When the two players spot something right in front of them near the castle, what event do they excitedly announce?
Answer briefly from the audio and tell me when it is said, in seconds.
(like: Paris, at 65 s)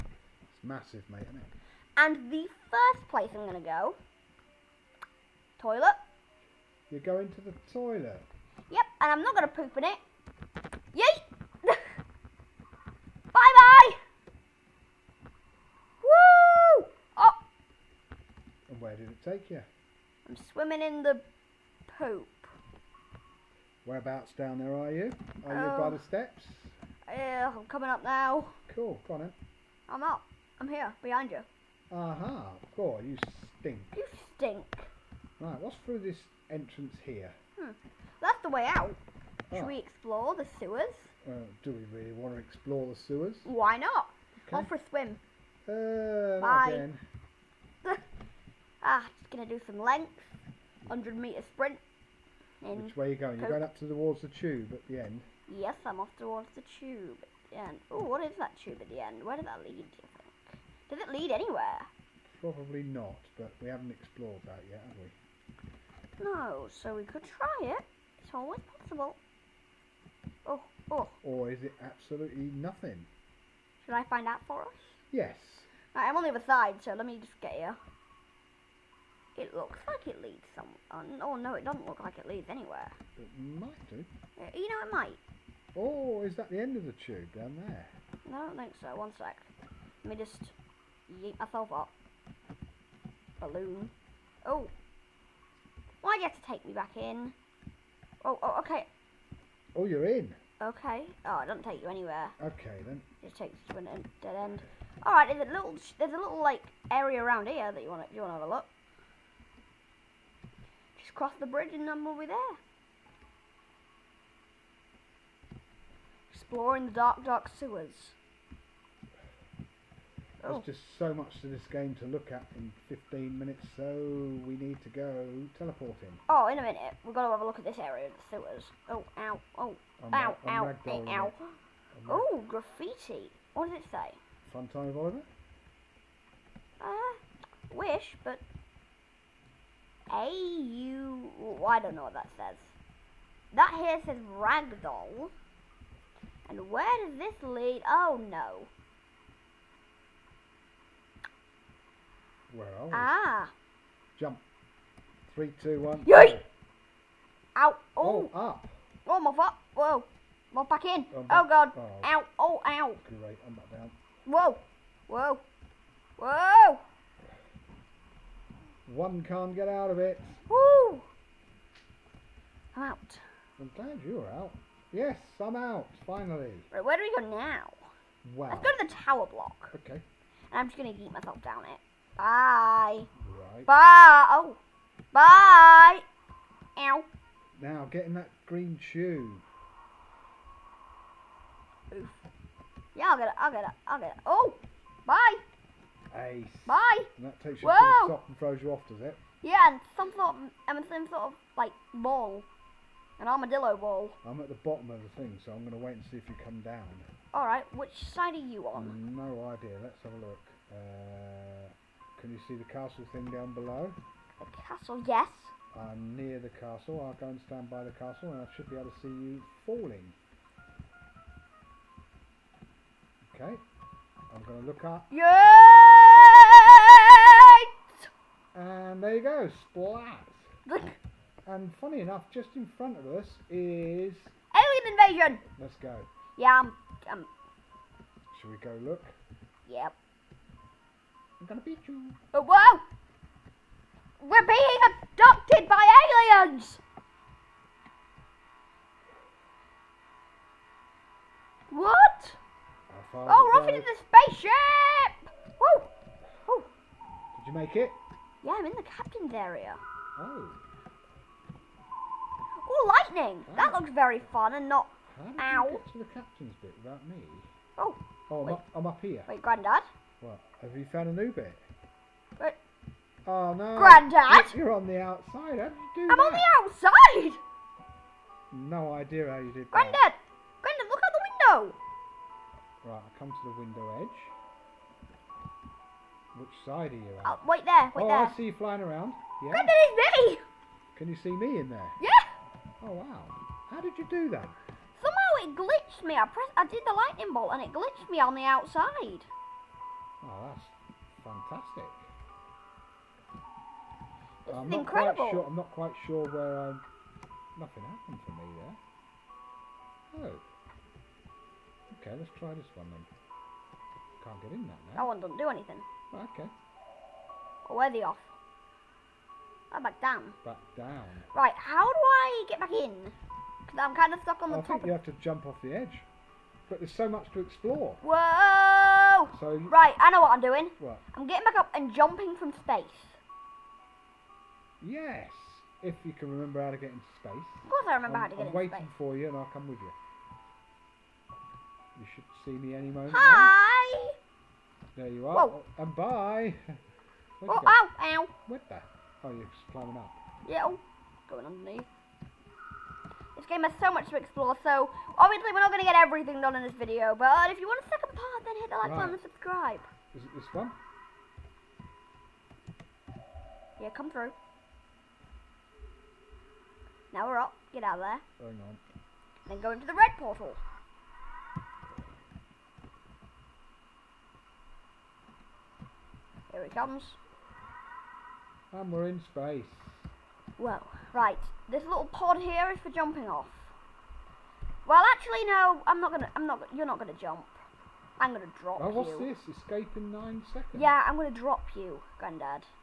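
Alien invasion, at 234 s.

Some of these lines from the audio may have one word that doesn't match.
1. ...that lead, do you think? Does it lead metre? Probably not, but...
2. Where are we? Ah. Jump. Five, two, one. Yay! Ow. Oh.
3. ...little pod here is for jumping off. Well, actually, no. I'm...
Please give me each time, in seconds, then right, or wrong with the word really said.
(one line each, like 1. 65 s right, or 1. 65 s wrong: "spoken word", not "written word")
1. 59 s wrong: "anywhere", not "metre"
2. 152 s wrong: "Three", not "Five"
3. 381 s right.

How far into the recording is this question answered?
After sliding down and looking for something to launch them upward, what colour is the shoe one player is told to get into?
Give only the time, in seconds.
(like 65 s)
188 s.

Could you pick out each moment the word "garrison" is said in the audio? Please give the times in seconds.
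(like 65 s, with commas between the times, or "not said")
not said.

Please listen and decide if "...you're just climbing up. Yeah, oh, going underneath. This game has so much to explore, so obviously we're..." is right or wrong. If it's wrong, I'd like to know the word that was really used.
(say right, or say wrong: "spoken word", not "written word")
right.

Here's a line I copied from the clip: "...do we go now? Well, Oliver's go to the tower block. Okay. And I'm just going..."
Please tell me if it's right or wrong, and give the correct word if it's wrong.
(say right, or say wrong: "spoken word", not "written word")
wrong: "Let", not "Oliver".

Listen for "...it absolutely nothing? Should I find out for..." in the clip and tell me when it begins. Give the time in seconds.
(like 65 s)
71 s.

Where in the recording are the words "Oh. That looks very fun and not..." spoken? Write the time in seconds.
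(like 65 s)
263 s.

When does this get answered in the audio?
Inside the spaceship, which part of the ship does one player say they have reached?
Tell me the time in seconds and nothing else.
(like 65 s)
258 s.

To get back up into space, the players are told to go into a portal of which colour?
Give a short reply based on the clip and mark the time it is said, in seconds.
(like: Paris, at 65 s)
Red, at 369 s.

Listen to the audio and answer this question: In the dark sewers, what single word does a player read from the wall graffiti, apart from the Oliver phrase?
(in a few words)
Ragdoll.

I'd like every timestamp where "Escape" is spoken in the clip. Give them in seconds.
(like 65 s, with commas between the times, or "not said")
389 s.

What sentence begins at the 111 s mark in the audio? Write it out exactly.
Just cross the bridge and then we'll be there.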